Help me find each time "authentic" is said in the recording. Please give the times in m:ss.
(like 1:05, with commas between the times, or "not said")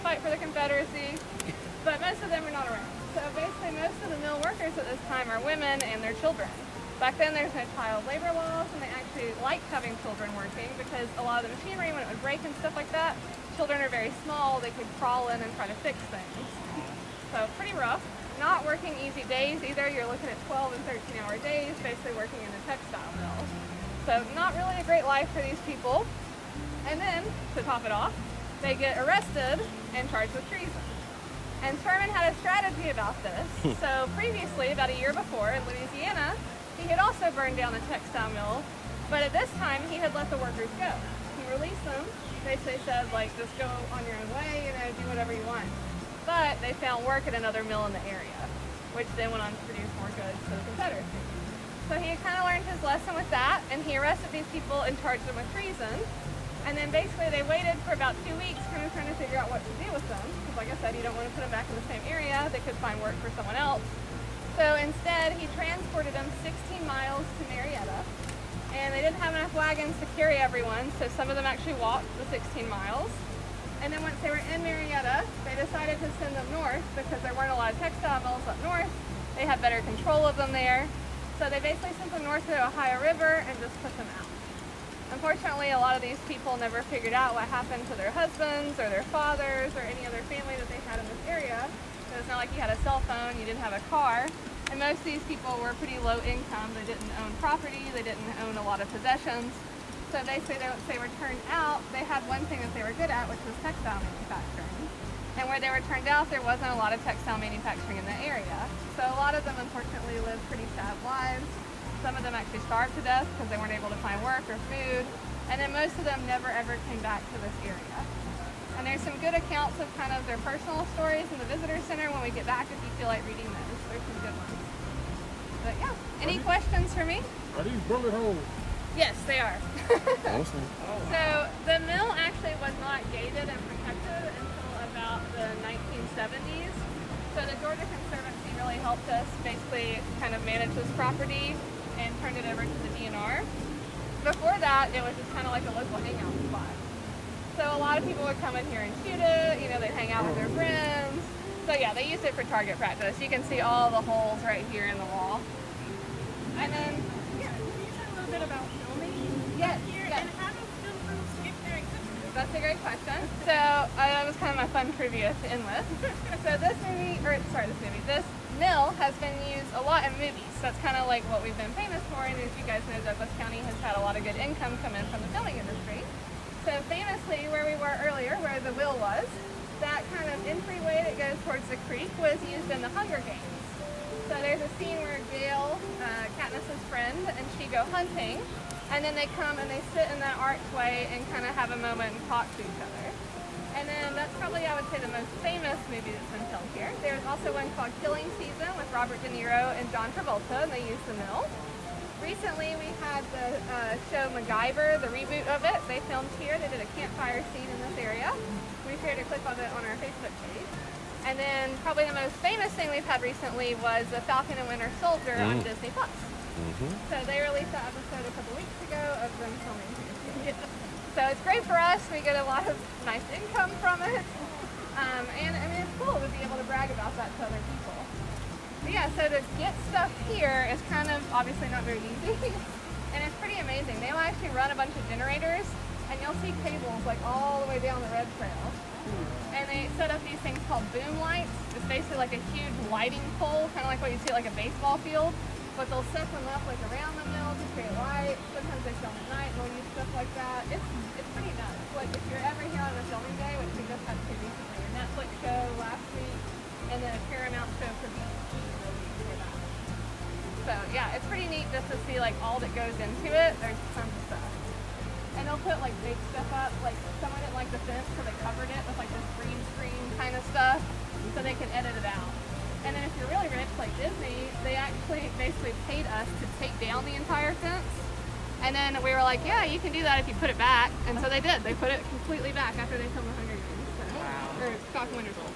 not said.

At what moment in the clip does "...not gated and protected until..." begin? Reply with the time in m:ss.
2:12.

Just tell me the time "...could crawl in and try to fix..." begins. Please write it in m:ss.
0:14.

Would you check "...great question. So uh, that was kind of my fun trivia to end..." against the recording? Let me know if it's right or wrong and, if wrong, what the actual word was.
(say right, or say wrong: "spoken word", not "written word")
right.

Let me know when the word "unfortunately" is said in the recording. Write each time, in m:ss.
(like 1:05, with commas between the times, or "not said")
1:25, 1:49.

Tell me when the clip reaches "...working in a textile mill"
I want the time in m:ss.
0:22.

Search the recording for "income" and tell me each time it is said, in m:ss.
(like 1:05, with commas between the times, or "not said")
1:36, 2:54, 3:43.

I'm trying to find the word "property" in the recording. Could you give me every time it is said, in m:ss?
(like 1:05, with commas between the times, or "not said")
1:37, 2:20.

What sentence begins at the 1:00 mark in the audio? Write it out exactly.
Because like I said, you don't want to put them back in the same area.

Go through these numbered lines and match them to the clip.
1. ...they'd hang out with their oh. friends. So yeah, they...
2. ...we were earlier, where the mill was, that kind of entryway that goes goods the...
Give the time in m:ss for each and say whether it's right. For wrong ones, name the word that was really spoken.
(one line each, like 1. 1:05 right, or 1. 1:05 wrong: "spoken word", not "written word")
1. 2:29 right
2. 2:57 wrong: "towards", not "goods".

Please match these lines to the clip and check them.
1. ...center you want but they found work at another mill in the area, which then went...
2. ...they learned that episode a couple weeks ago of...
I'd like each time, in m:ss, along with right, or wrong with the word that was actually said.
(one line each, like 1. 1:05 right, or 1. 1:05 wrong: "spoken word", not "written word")
1. 0:45 wrong: "whatever", not "center"
2. 3:37 wrong: "released", not "learned".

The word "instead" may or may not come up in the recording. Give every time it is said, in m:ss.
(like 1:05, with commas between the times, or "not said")
1:04.